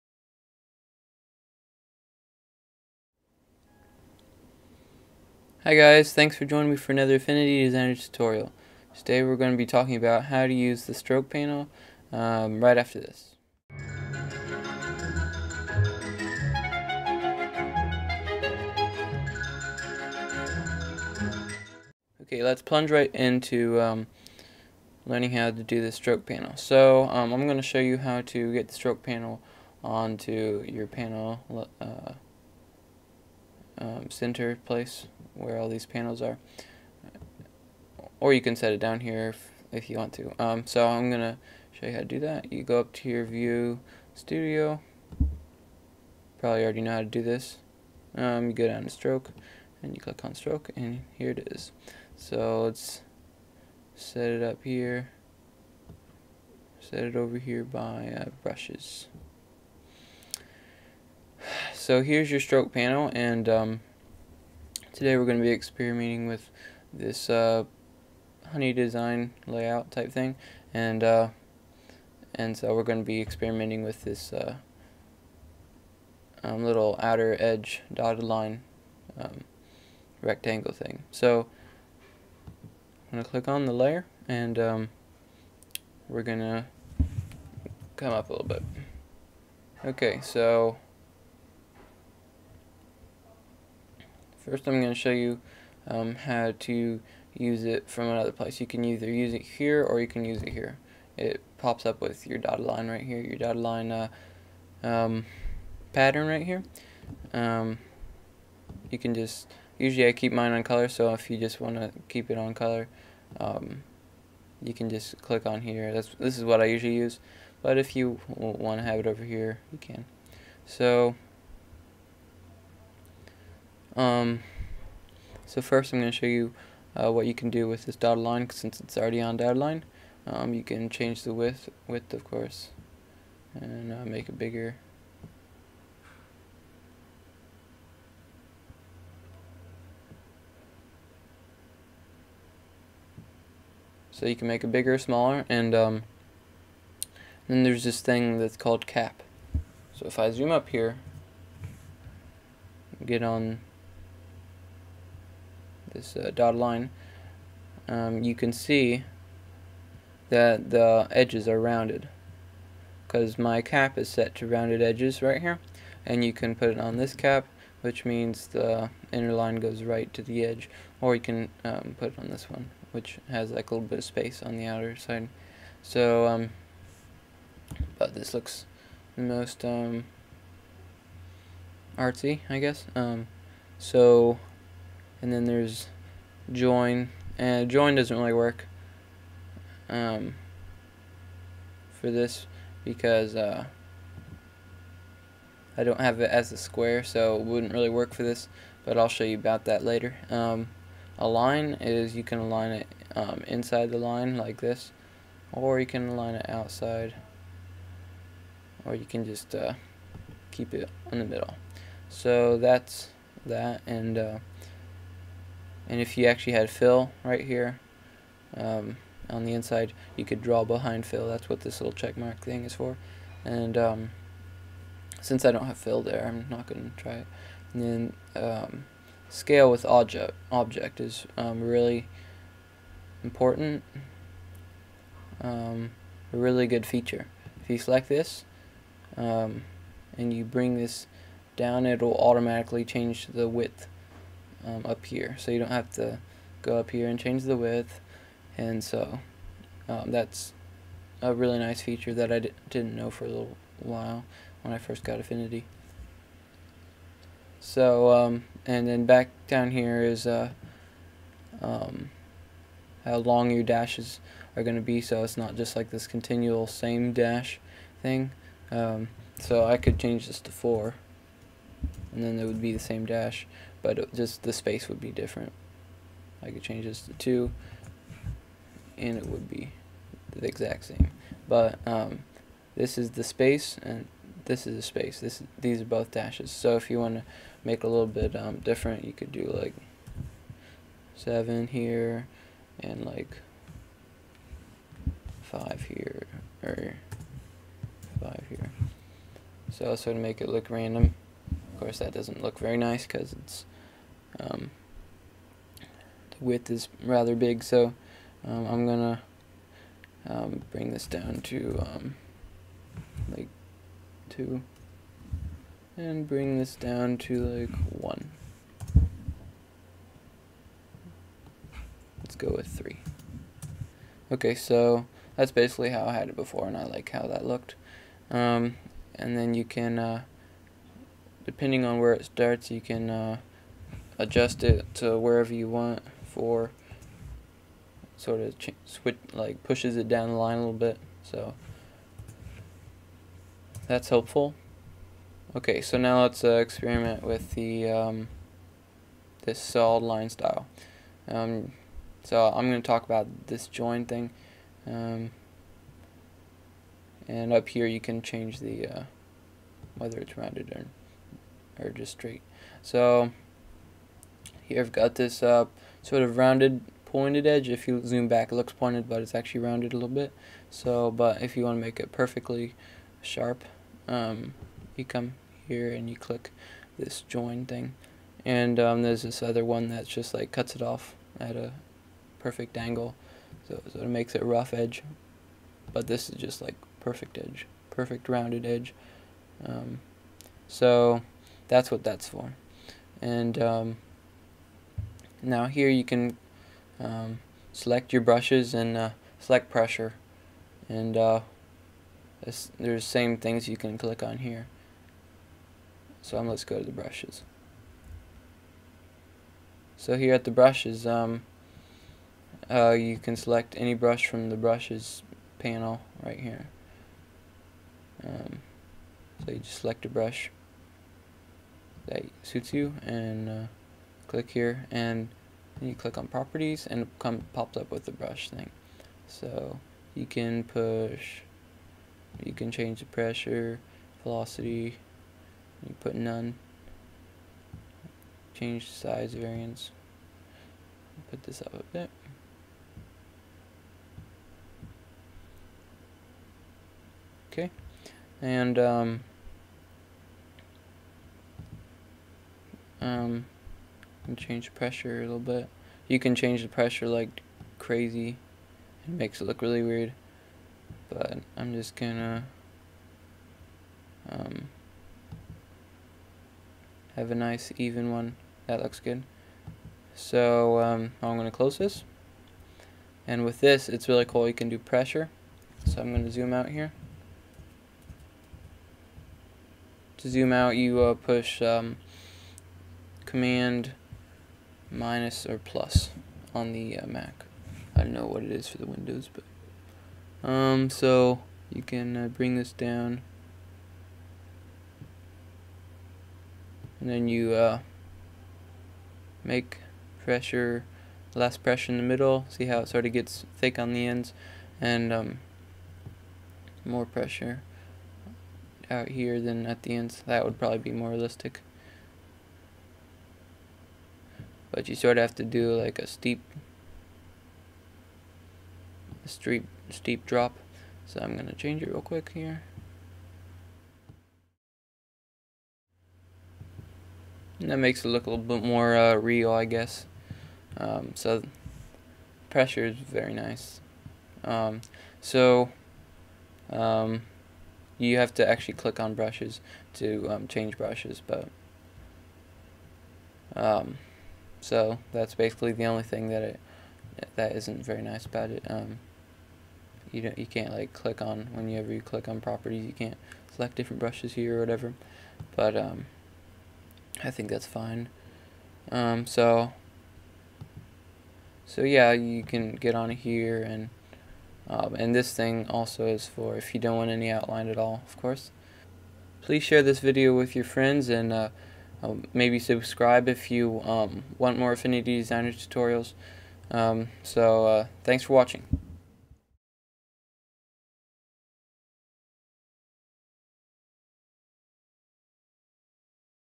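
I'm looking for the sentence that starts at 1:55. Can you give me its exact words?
That's This is what I usually use, but if you want to have it over here, you can.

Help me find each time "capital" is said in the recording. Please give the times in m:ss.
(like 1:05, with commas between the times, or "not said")
not said.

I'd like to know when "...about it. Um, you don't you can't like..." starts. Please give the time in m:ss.
9:08.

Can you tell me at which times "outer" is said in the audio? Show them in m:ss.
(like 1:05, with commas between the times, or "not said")
1:17, 2:54.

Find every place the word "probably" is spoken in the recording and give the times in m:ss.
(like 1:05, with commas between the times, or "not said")
0:46, 8:30.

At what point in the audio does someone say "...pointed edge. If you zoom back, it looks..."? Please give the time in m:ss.
6:07.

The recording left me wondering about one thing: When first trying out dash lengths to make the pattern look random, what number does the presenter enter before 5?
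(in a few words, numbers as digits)
7.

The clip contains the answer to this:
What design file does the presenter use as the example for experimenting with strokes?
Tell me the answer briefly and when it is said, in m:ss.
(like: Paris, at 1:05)
Honey design, at 1:08.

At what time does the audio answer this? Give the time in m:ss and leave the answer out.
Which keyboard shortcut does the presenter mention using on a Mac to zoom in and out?
8:03.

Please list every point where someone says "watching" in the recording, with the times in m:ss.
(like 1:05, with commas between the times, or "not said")
9:38.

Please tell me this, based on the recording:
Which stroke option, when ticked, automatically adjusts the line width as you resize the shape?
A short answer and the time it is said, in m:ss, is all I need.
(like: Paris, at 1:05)
Scale with object, at 3:49.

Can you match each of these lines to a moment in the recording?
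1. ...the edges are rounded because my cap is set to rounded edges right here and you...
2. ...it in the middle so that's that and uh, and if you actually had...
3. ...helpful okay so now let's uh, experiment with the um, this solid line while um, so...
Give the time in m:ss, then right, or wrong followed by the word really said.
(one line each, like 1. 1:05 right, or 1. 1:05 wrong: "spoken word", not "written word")
1. 2:40 right
2. 3:30 right
3. 5:44 wrong: "style", not "while".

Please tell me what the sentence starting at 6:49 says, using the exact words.
So here at the brushes, um, uh, you can select any brush from the brushes panel right here.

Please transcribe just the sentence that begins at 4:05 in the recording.
So you don't have to go up here and change the width.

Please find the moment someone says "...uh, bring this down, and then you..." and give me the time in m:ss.
8:12.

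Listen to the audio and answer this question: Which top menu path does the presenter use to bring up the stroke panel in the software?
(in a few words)
View Studio.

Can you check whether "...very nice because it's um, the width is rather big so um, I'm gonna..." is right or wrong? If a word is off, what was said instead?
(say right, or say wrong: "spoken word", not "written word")
right.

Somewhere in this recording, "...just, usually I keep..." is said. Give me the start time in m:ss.
1:49.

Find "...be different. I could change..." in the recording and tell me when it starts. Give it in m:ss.
4:34.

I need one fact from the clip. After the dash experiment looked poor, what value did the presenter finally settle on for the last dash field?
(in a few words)
3.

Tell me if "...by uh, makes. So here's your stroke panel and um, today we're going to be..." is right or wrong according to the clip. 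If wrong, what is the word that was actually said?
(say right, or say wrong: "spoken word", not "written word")
wrong: "brushes", not "makes".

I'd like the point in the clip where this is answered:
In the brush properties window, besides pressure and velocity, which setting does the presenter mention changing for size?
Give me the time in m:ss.
7:18.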